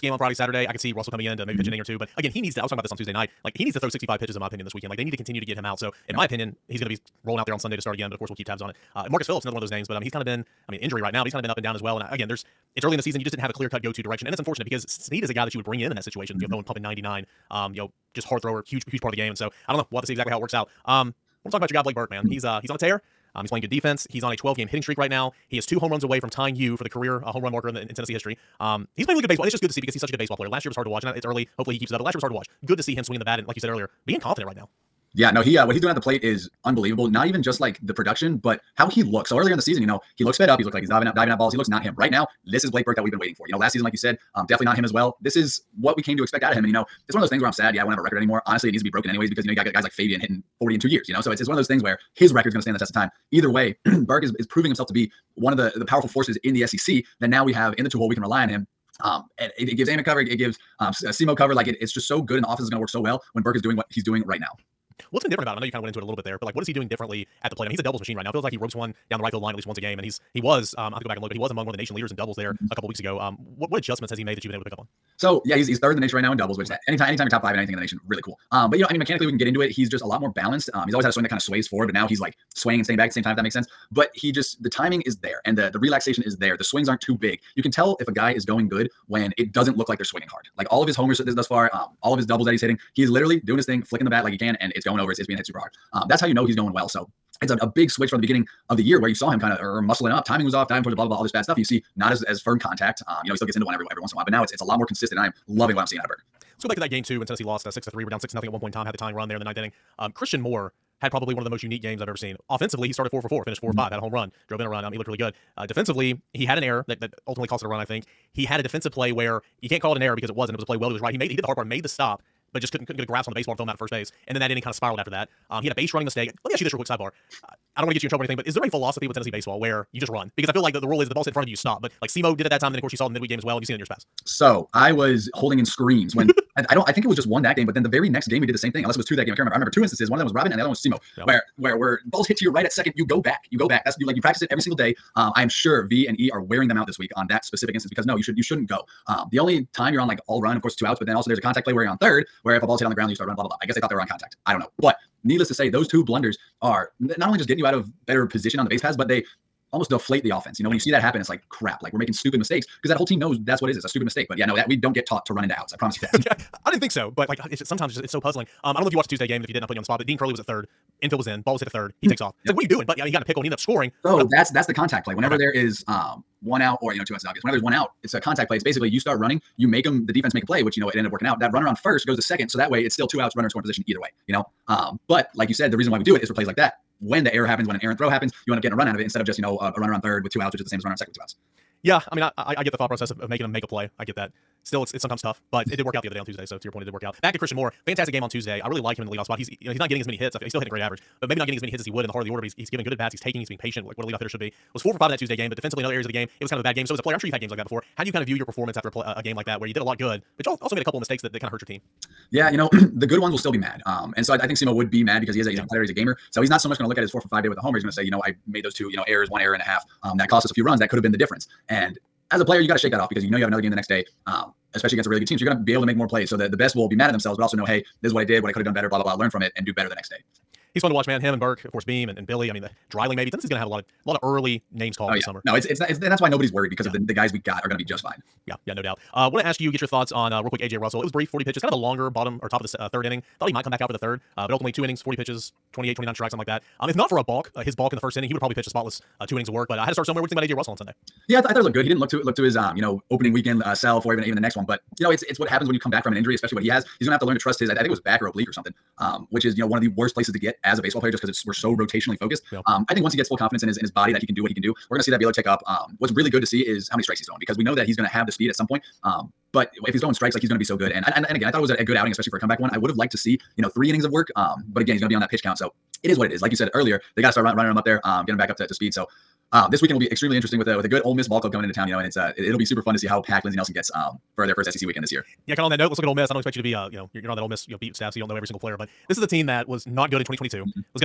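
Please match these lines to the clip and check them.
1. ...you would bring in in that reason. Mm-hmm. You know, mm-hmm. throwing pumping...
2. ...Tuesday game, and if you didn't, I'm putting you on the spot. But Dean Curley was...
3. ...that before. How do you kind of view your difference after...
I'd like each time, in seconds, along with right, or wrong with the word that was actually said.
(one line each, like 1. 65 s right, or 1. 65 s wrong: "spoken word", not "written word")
1. 15 s wrong: "situation", not "reason"
2. 169 s right
3. 207 s wrong: "performance", not "difference".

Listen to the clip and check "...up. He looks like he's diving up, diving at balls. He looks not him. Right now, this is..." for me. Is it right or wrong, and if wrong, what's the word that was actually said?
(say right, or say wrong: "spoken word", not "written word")
right.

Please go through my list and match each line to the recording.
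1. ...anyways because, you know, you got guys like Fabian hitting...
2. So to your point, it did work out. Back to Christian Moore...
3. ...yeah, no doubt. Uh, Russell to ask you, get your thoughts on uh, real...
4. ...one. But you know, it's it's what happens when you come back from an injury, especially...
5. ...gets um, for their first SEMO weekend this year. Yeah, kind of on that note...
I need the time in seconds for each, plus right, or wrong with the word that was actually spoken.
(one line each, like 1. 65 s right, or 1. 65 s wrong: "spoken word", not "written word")
1. 49 s right
2. 196 s right
3. 238 s wrong: "Want", not "Russell"
4. 254 s right
5. 283 s wrong: "SEC", not "SEMO".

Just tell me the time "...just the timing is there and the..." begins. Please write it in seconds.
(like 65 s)
84 s.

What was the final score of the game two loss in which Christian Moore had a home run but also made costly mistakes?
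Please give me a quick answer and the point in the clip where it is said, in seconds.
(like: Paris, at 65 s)
6 to 3, at 107 s.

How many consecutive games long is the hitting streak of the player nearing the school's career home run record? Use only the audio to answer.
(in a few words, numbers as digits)
12.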